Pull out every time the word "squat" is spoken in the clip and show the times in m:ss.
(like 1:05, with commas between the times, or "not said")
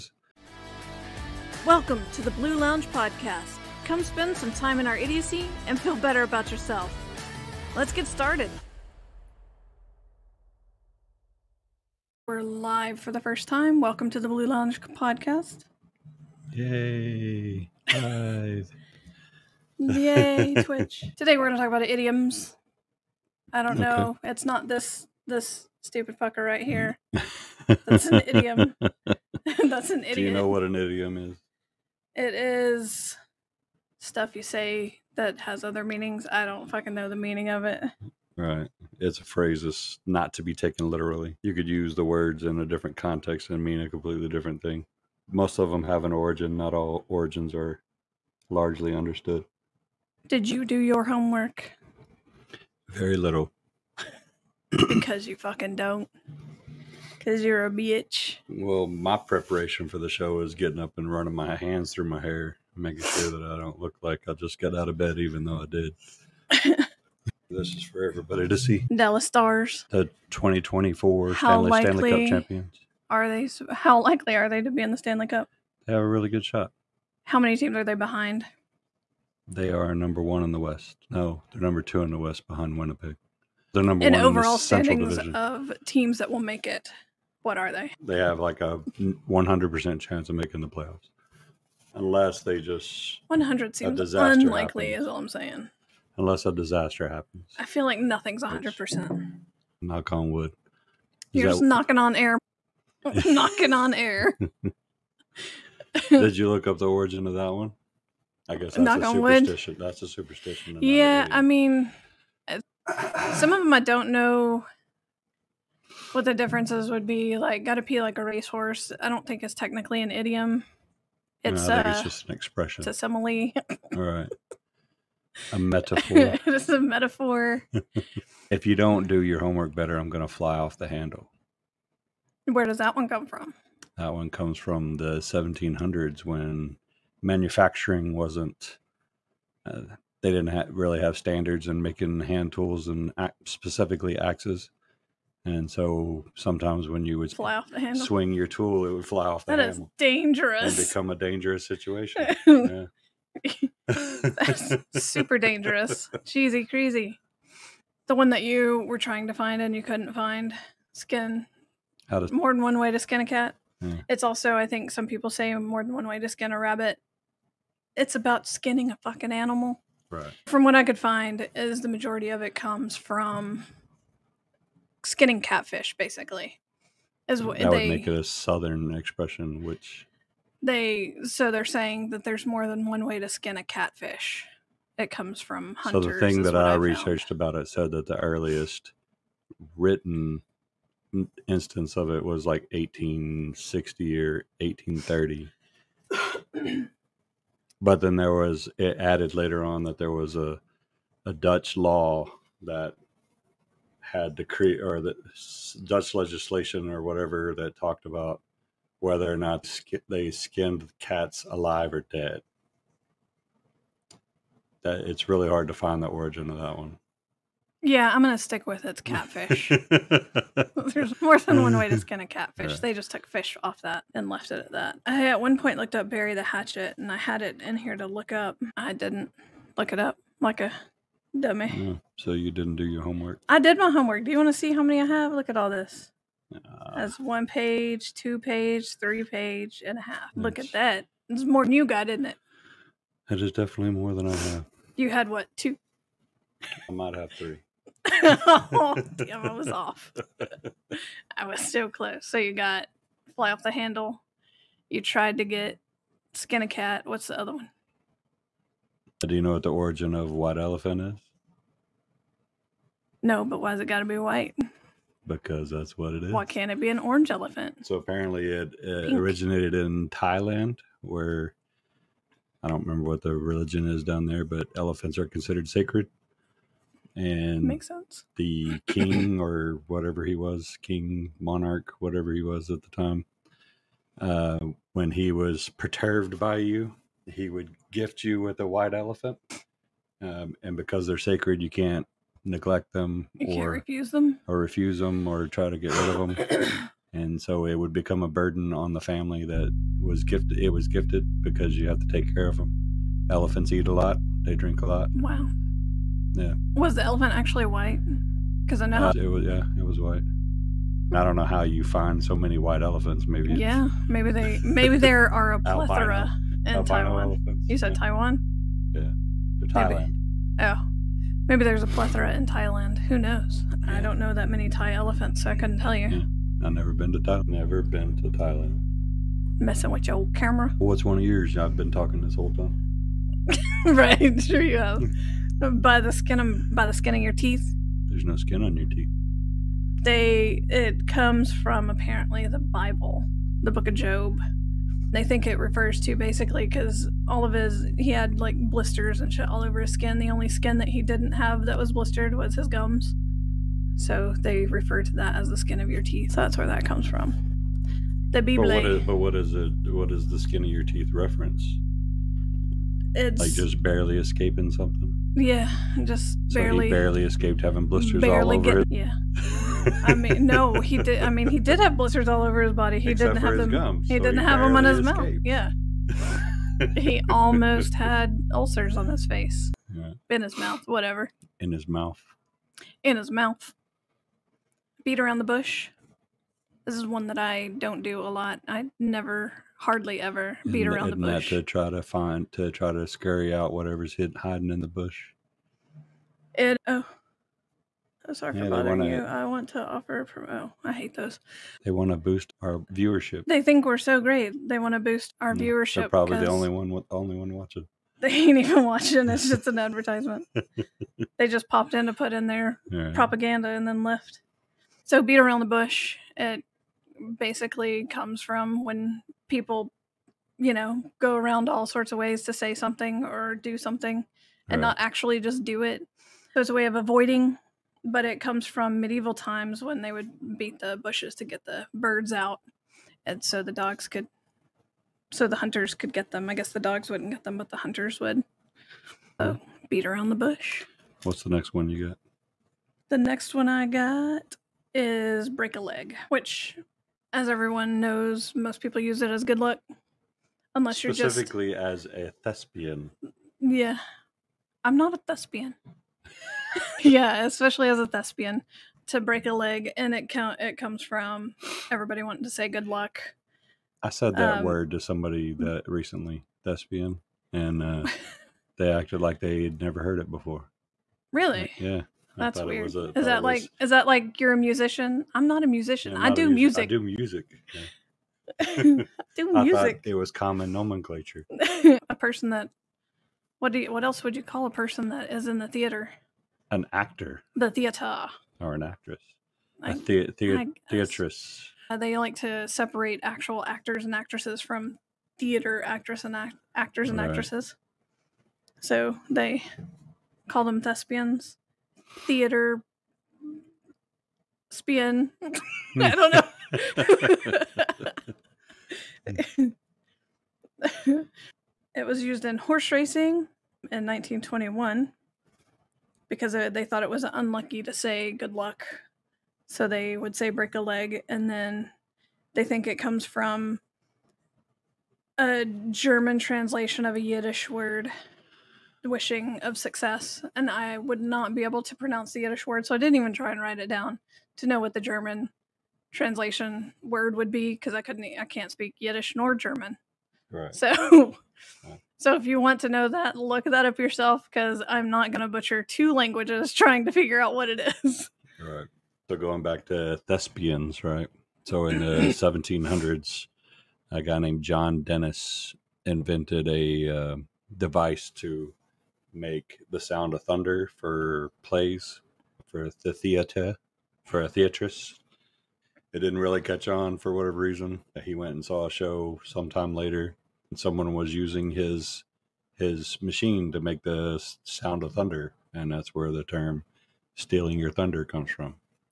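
not said.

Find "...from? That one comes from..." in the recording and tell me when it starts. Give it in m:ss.
2:13.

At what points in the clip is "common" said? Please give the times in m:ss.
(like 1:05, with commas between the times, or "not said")
8:00.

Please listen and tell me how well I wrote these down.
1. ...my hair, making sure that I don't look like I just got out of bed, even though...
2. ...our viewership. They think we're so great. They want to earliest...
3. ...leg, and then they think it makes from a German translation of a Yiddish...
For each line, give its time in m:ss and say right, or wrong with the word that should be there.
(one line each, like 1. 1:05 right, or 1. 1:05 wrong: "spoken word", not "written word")
1. 1:02 right
2. 6:42 wrong: "boost", not "earliest"
3. 8:40 wrong: "comes", not "makes".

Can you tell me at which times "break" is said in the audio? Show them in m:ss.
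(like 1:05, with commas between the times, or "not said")
7:25, 7:39, 8:40.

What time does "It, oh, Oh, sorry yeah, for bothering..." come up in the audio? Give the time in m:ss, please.
6:36.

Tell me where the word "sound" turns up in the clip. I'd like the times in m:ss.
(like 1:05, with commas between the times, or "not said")
9:19, 9:34.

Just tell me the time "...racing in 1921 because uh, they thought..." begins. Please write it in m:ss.
8:32.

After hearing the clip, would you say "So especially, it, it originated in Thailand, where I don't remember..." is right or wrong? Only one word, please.
wrong.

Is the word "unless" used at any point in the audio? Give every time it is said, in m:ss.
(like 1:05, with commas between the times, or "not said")
1:31, 1:36, 7:30.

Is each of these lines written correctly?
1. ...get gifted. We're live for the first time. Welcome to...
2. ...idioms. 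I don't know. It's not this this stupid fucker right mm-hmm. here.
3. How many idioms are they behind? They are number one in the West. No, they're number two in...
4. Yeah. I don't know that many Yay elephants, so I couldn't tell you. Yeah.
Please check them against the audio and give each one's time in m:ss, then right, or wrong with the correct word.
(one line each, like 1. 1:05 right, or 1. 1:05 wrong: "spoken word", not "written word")
1. 0:07 wrong: "started", not "gifted"
2. 0:21 right
3. 1:17 wrong: "teams", not "idioms"
4. 5:23 wrong: "Thai", not "Yay".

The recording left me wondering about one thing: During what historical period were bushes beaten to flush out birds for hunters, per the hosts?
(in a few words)
Medieval times.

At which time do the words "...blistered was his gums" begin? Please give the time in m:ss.
5:51.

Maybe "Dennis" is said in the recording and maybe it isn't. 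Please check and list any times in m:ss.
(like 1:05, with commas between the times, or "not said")
9:15.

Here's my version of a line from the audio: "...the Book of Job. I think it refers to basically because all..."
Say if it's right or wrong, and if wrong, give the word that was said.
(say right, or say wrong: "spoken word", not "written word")
right.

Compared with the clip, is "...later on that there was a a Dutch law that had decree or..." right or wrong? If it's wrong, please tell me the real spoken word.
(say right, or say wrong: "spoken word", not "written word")
right.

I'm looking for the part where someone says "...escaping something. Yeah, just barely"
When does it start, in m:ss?
6:04.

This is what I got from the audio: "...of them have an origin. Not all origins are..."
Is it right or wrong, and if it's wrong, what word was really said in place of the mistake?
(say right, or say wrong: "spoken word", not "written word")
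right.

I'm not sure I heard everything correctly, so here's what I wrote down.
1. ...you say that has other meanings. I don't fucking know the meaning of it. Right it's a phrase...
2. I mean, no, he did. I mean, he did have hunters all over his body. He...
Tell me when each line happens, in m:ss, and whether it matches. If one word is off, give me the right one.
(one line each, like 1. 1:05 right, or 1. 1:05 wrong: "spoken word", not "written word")
1. 0:34 right
2. 6:10 wrong: "blisters", not "hunters".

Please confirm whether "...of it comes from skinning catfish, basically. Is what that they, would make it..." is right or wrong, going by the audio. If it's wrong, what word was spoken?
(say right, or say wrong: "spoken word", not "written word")
right.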